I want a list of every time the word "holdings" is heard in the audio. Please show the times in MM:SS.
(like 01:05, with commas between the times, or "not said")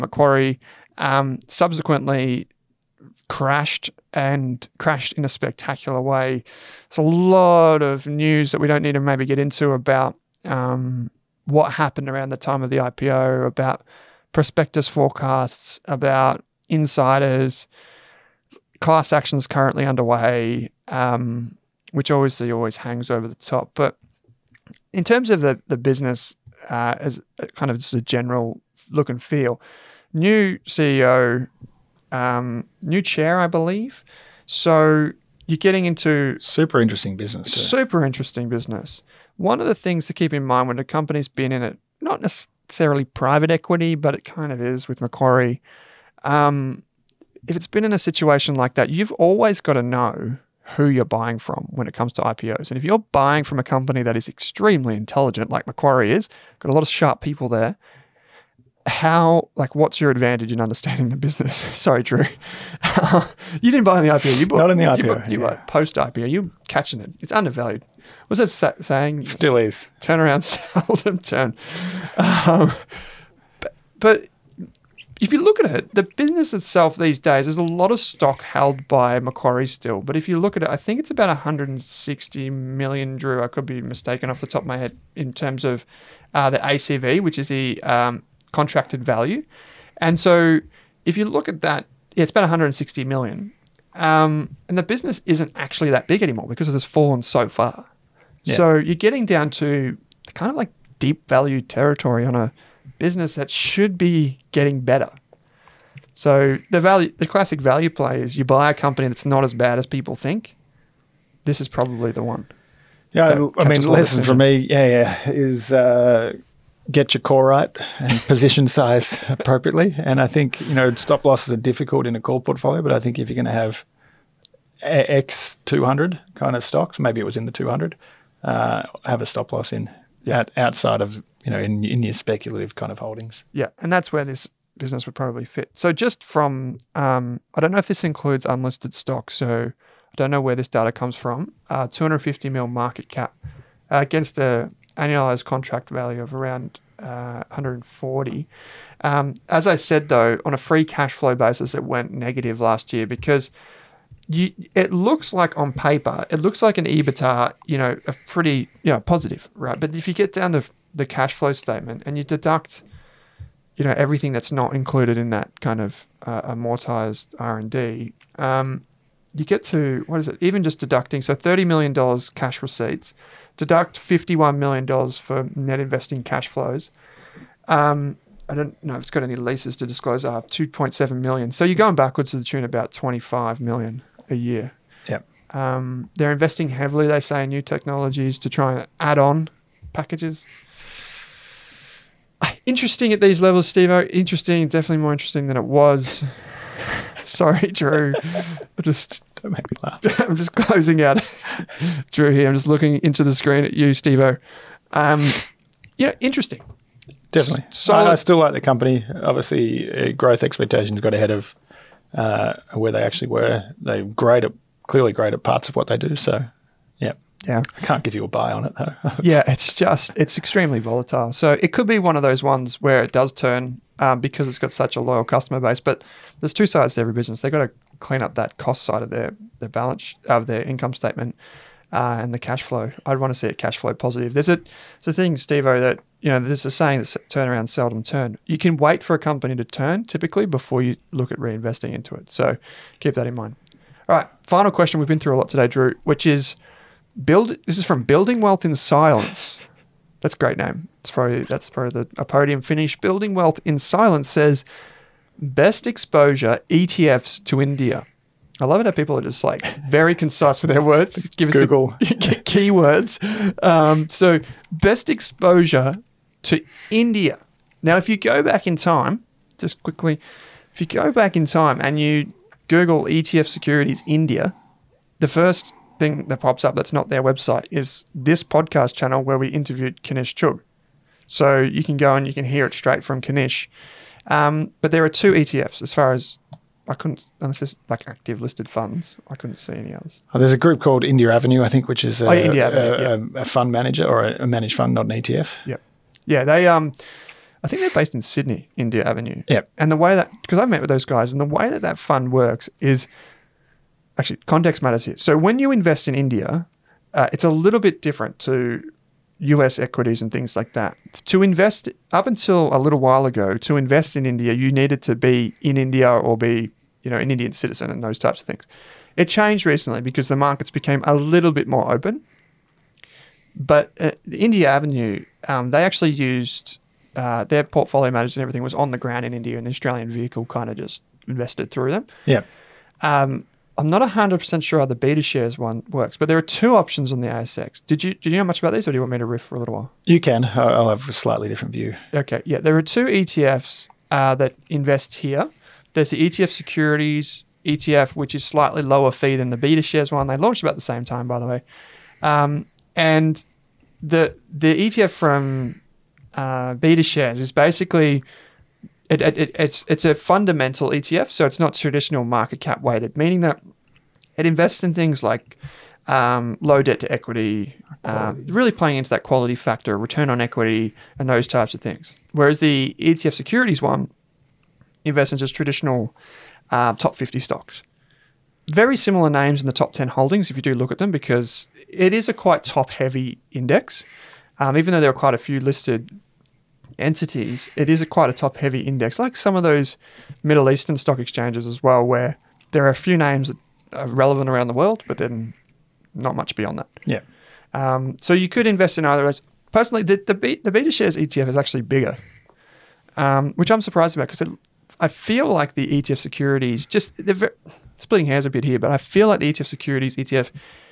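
02:12, 06:20.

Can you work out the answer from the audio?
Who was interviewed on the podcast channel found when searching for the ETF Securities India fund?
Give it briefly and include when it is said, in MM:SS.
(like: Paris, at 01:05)
Kanish Chugh, at 04:40.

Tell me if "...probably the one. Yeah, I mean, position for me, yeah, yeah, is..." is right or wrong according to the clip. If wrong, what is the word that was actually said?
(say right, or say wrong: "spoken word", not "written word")
wrong: "lesson", not "position".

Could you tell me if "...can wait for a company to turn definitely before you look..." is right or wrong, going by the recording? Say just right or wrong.
wrong.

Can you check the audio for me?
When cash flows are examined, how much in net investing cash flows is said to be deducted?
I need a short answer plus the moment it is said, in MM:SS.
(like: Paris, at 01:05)
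$51 million, at 02:53.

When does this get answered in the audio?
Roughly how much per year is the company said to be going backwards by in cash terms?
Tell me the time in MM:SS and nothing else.
03:02.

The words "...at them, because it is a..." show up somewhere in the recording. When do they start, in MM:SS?
06:20.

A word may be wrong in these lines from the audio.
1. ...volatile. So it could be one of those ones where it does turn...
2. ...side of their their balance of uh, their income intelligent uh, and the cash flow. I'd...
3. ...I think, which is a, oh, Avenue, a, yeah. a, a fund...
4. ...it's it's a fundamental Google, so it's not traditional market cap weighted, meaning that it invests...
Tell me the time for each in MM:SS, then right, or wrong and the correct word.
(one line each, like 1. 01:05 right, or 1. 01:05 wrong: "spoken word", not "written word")
1. 03:40 right
2. 03:48 wrong: "statement", not "intelligent"
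3. 04:51 right
4. 05:59 wrong: "ETF", not "Google".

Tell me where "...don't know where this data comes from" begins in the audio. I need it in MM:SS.
02:20.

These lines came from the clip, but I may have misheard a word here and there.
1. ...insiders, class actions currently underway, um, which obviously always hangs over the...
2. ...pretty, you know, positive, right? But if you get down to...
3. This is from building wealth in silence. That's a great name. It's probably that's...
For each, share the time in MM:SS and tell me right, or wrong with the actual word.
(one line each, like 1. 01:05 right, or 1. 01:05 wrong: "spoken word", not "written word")
1. 00:16 right
2. 02:38 right
3. 04:07 right.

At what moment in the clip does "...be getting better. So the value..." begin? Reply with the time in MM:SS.
01:43.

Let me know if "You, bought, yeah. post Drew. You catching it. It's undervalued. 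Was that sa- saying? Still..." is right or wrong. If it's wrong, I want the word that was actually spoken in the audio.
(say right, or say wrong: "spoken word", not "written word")
wrong: "IPO", not "Drew".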